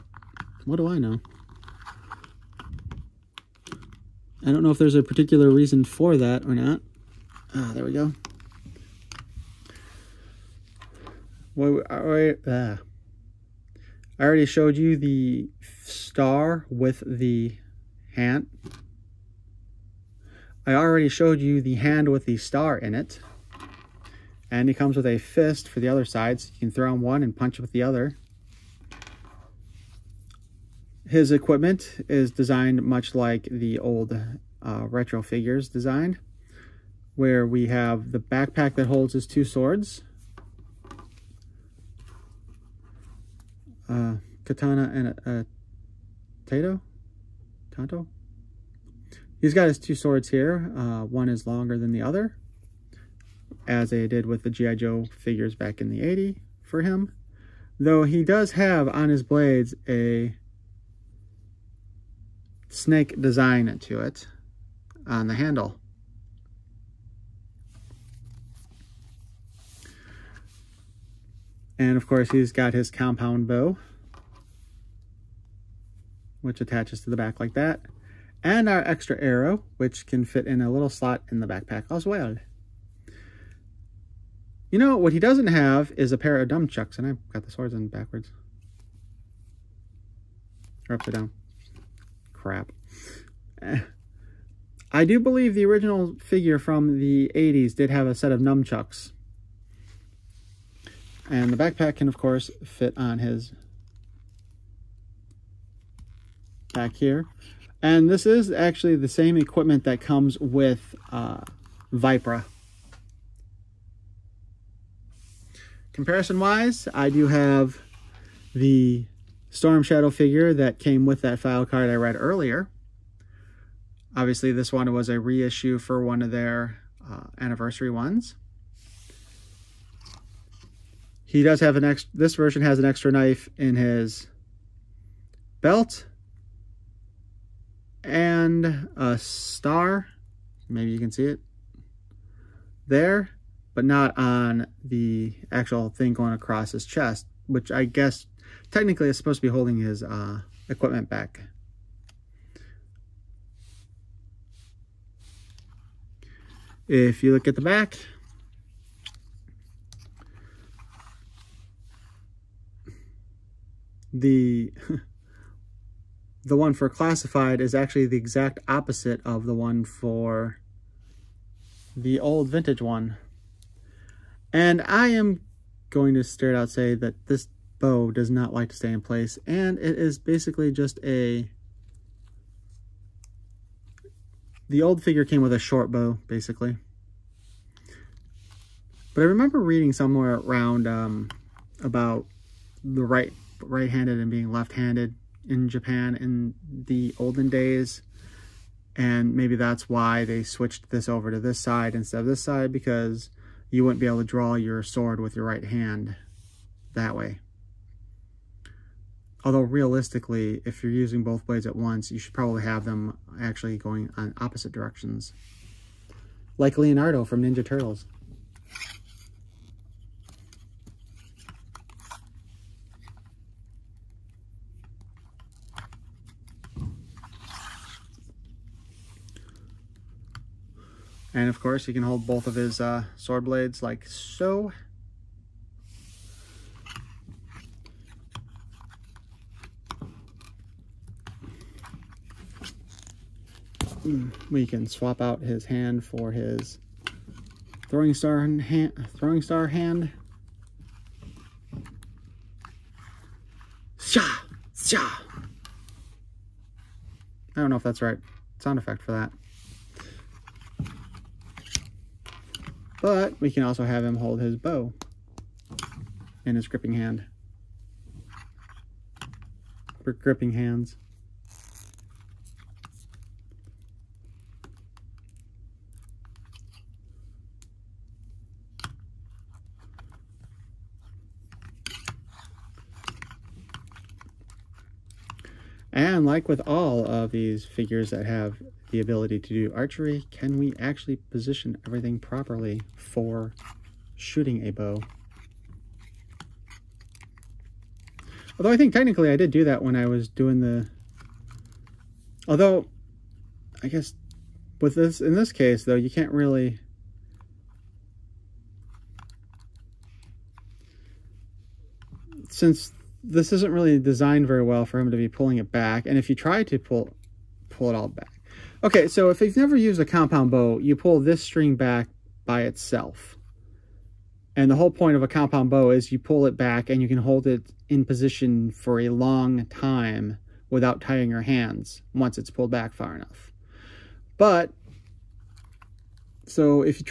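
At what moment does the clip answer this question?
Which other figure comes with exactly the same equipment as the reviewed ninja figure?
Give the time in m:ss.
1:51.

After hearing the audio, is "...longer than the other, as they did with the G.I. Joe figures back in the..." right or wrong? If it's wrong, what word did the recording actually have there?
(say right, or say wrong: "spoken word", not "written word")
right.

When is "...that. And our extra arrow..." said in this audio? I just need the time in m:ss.
1:17.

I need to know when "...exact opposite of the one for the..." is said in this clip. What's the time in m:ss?
2:48.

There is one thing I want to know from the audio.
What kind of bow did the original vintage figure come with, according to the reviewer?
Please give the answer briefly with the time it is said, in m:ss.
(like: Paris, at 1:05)
Short bow, at 3:05.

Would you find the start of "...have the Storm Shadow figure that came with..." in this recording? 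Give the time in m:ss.
1:57.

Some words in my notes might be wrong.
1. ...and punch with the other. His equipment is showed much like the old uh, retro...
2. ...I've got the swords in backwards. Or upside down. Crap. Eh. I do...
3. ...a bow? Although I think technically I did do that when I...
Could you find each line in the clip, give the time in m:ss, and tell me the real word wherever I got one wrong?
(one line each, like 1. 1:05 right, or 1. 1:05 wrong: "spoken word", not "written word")
1. 0:27 wrong: "designed", not "showed"
2. 1:27 right
3. 4:54 right.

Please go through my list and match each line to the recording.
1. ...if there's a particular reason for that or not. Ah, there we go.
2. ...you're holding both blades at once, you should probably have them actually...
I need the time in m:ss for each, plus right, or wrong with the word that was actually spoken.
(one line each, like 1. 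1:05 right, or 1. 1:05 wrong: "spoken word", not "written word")
1. 0:04 right
2. 3:30 wrong: "using", not "holding".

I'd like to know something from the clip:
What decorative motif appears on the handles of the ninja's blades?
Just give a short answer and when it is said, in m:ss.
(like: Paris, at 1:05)
Snake, at 1:02.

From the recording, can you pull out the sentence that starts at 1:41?
And the backpack can, of course, fit on his back here.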